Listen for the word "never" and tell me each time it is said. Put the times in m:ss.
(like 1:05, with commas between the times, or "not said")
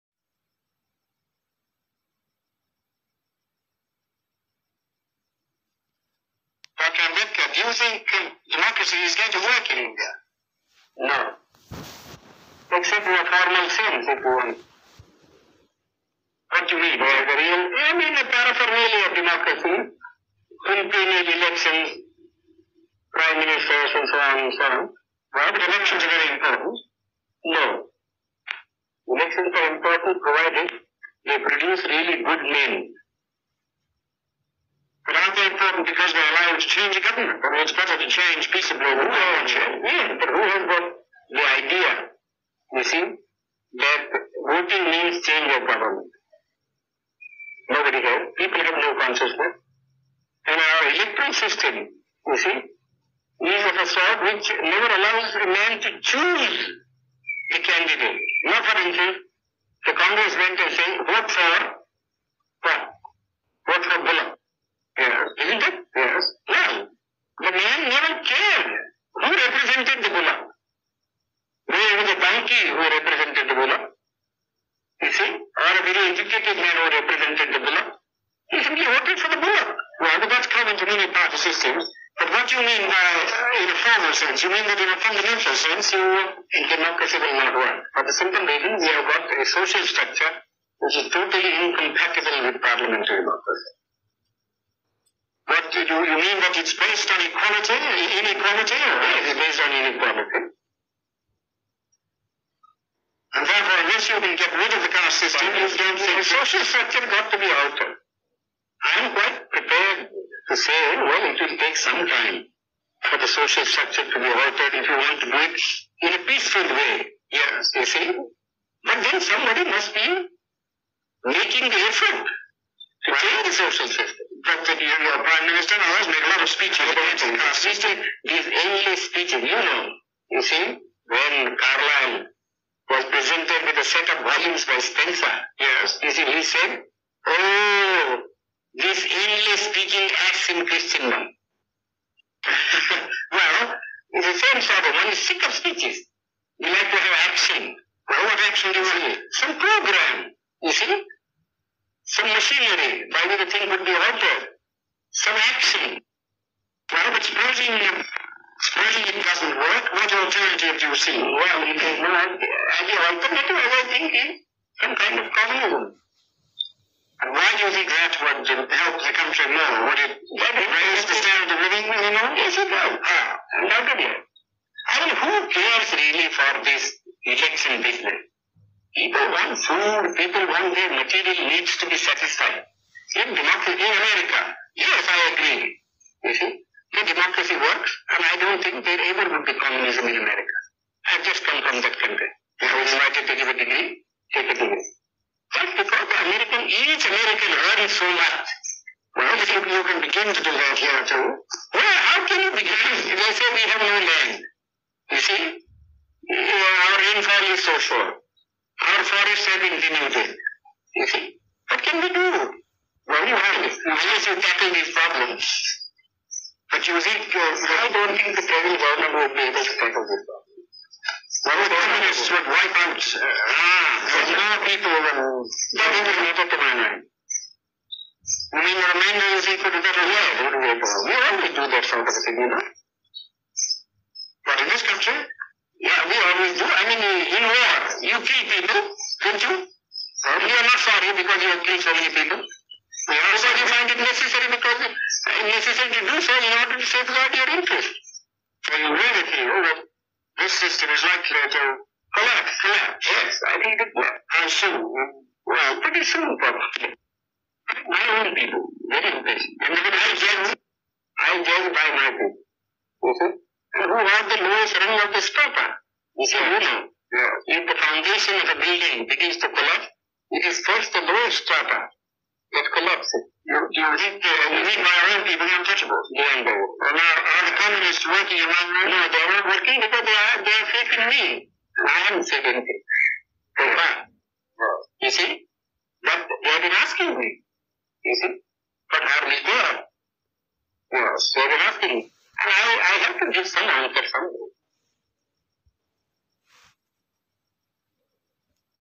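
0:54, 1:07.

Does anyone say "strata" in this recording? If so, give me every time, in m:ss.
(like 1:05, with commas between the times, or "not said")
4:31.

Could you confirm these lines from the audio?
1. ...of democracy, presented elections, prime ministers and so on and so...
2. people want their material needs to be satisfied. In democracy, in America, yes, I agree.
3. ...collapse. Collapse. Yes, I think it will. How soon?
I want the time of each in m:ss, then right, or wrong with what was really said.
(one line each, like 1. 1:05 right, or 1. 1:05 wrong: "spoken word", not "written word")
1. 0:19 wrong: "impeded", not "presented"
2. 2:59 right
3. 4:12 right.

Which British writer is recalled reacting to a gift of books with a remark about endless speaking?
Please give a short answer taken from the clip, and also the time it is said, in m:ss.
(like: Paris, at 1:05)
Carlyle, at 2:11.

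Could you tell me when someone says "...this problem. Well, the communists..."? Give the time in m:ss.
3:40.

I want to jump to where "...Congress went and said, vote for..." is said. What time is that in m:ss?
0:59.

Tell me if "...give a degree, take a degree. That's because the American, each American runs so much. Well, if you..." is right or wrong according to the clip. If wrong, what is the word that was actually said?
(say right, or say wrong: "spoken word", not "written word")
right.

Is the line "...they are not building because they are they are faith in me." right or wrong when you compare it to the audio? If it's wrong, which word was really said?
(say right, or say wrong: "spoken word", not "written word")
wrong: "working", not "building".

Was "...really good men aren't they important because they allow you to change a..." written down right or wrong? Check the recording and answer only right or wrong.
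right.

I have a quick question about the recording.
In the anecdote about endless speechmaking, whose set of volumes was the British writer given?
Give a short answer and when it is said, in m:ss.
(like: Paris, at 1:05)
Spencer, at 2:14.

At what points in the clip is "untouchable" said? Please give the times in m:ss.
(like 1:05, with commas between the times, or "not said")
4:35.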